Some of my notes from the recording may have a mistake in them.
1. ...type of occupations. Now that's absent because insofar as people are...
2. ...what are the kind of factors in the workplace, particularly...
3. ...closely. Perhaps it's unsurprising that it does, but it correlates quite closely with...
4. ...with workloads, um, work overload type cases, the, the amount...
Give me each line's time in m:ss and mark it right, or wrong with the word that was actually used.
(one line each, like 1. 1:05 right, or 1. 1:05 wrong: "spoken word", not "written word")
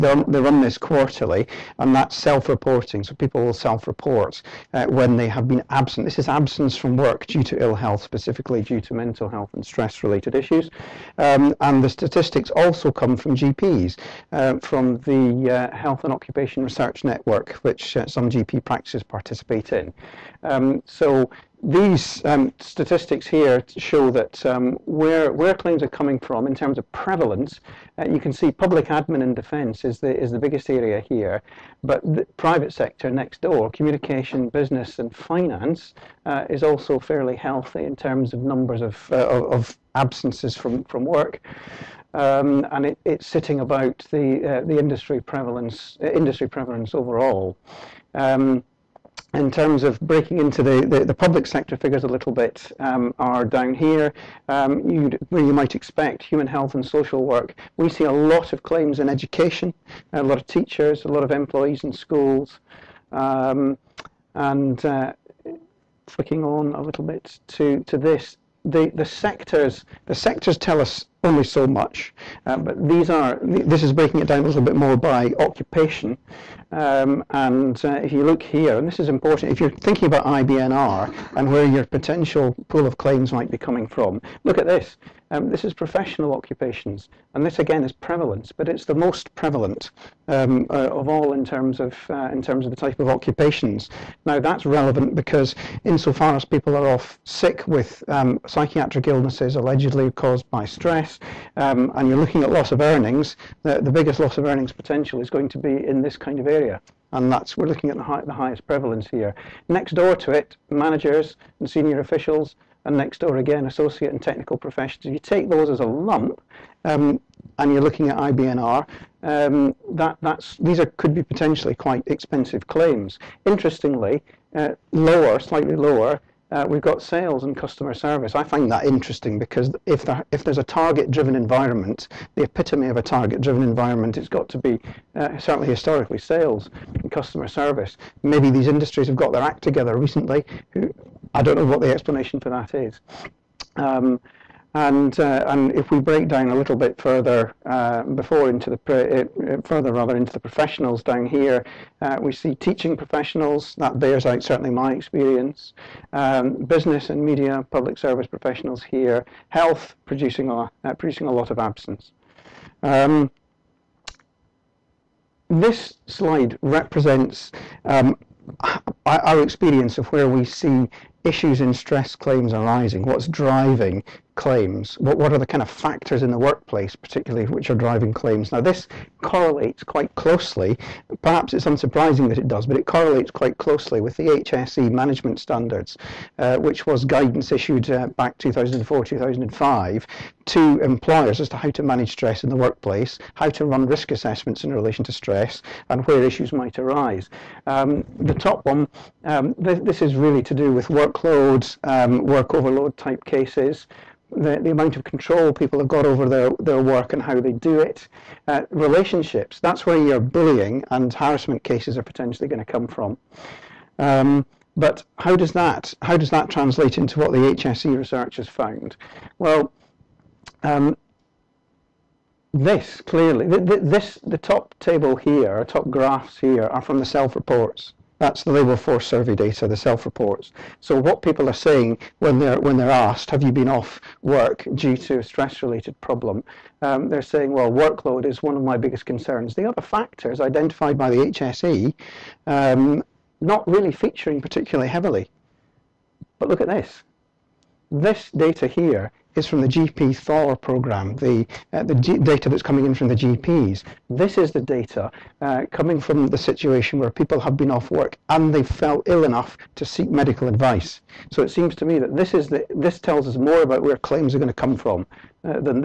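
1. 1:32 wrong: "relevant", not "absent"
2. 2:55 right
3. 3:00 right
4. 3:20 right.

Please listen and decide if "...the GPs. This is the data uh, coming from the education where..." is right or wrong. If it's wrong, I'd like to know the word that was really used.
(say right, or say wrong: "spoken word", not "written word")
wrong: "situation", not "education".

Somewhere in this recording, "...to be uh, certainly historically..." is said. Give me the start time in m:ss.
2:14.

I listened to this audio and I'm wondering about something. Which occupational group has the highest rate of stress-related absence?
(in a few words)
Professional occupations.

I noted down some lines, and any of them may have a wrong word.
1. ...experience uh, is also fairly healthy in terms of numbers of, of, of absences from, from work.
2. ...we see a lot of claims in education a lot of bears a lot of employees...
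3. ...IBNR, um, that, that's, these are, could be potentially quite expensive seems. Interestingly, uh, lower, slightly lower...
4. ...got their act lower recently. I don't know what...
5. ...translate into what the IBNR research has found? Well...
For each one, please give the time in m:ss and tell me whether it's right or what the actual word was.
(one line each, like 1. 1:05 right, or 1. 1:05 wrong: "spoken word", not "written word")
1. 0:35 wrong: "finance", not "experience"
2. 0:57 wrong: "teachers", not "bears"
3. 1:58 wrong: "claims", not "seems"
4. 2:19 wrong: "together", not "lower"
5. 3:36 wrong: "HSE", not "IBNR".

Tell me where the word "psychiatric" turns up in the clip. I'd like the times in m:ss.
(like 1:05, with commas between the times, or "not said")
1:38.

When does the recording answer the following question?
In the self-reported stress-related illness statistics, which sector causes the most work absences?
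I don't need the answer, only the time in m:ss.
0:28.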